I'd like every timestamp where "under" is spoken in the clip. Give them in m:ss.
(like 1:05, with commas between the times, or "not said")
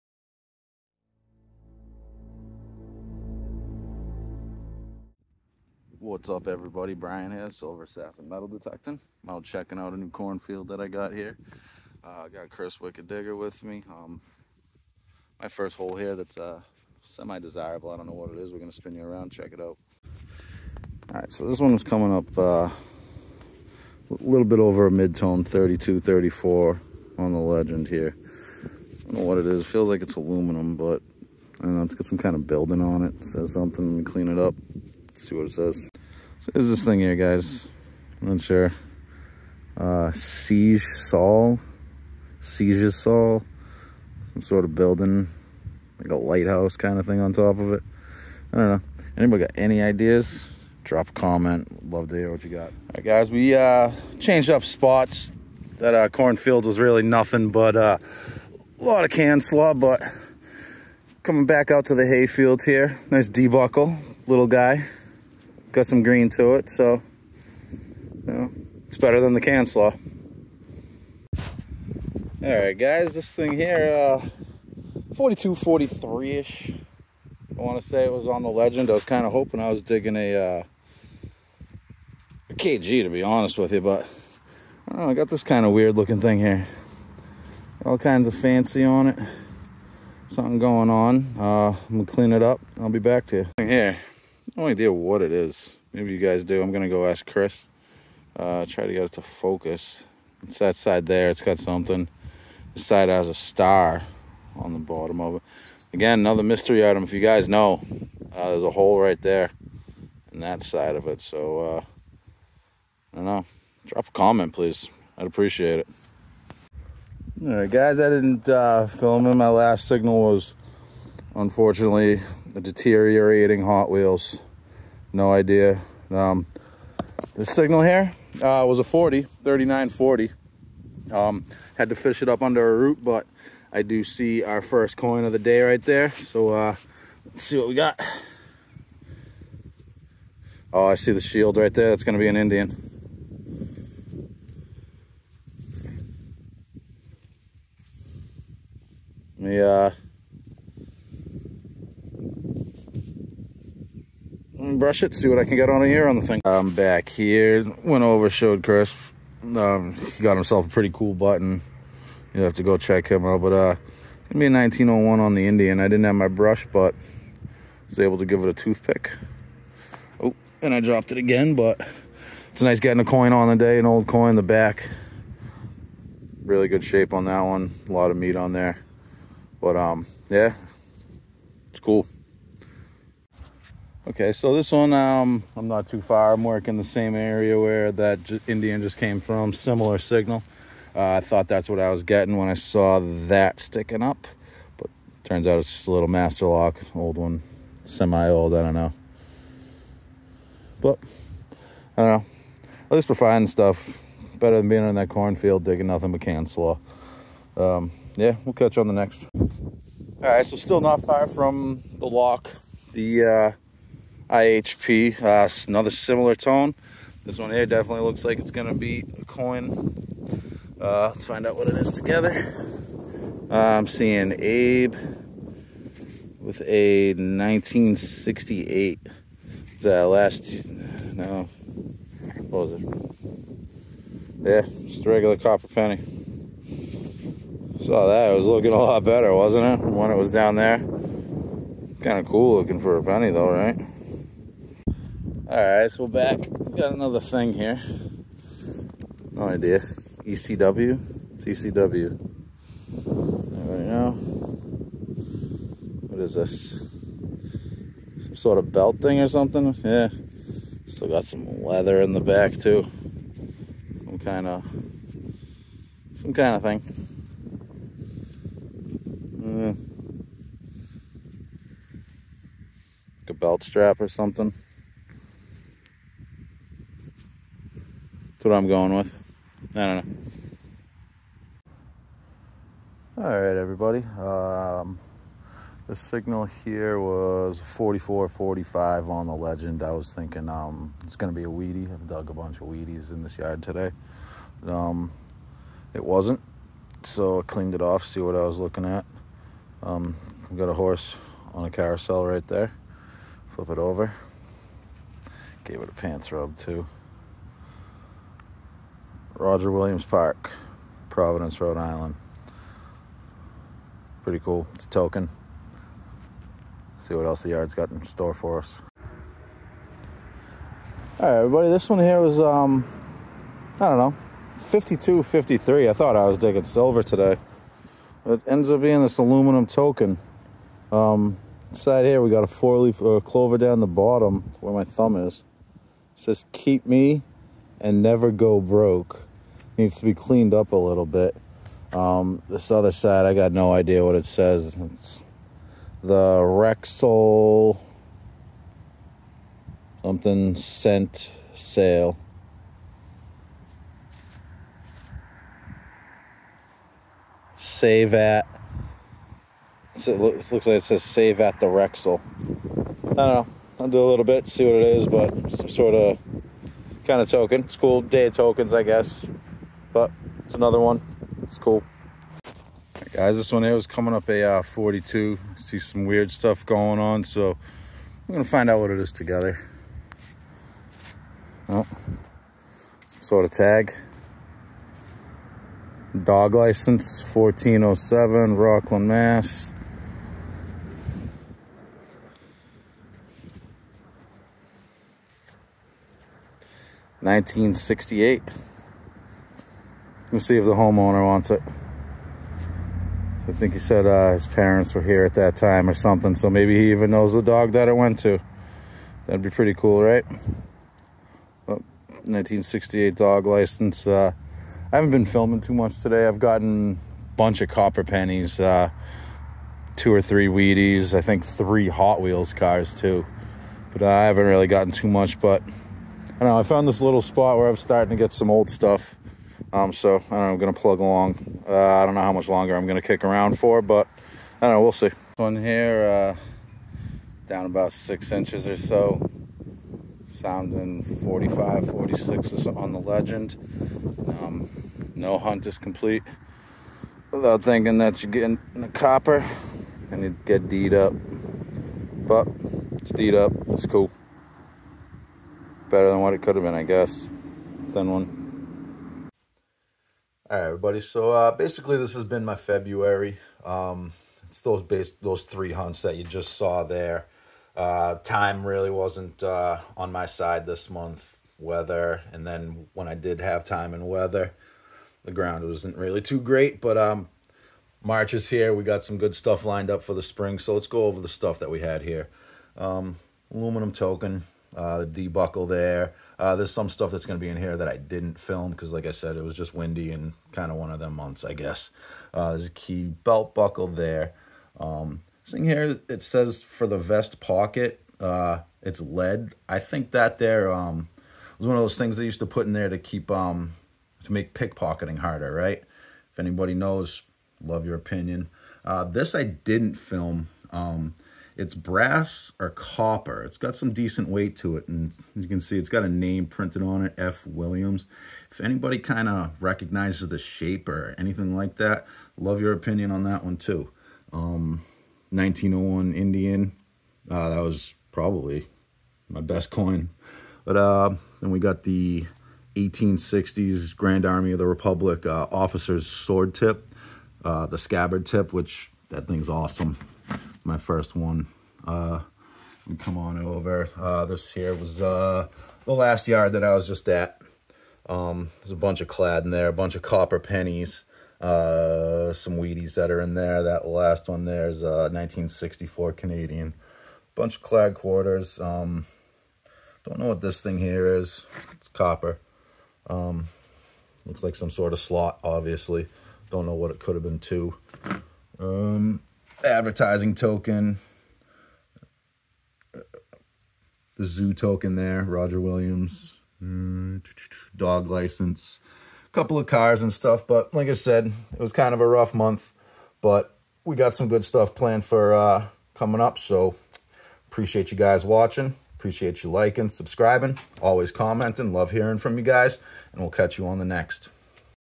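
2:12.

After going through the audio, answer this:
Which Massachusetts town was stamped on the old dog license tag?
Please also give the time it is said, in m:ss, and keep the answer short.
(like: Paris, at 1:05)
Rockland, at 6:28.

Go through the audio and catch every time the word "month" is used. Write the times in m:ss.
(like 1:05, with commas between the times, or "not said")
7:50, 8:11, 9:42.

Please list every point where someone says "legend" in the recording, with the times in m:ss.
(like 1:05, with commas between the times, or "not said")
0:27, 1:18, 4:49, 7:22.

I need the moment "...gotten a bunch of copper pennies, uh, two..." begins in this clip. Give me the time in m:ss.
6:56.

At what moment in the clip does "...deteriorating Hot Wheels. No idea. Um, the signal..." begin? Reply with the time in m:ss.
2:02.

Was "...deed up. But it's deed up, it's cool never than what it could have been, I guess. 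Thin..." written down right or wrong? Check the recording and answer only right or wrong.
wrong.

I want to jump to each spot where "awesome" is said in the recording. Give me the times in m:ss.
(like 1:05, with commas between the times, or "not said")
8:59.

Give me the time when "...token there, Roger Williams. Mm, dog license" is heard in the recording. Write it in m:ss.
9:34.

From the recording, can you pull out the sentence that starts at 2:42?
You'll have to go check him out, but uh, it's gonna be a 1901 on the Indian.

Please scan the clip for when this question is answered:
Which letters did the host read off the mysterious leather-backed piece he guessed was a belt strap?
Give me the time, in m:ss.
4:11.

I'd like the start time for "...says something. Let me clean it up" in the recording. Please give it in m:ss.
0:33.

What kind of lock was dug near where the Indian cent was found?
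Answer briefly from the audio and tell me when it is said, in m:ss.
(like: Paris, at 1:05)
master lock, at 3:16.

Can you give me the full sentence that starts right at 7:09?
Um, so I don't know, I'm gonna plug along.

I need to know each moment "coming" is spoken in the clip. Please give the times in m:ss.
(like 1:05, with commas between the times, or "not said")
0:21, 1:01, 6:13, 9:45.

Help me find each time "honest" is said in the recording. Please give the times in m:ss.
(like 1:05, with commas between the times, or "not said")
1:23.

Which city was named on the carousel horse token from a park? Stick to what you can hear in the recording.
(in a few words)
Providence.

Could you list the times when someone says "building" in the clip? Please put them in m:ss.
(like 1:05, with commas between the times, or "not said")
0:32, 0:44.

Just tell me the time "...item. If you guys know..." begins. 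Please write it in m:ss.
1:46.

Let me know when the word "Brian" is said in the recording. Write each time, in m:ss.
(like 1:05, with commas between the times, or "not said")
0:06.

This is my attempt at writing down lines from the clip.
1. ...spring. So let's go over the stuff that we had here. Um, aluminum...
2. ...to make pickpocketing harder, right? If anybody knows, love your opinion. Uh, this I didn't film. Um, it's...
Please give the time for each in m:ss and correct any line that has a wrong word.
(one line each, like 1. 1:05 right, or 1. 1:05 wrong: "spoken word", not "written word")
1. 8:00 right
2. 8:24 right.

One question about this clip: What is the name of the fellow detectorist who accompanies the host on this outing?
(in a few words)
Chris Wicked Digger.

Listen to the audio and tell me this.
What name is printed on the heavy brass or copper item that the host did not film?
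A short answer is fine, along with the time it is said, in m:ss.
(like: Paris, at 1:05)
F. Williams, at 8:37.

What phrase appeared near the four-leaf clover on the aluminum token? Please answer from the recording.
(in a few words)
keep me and never go broke.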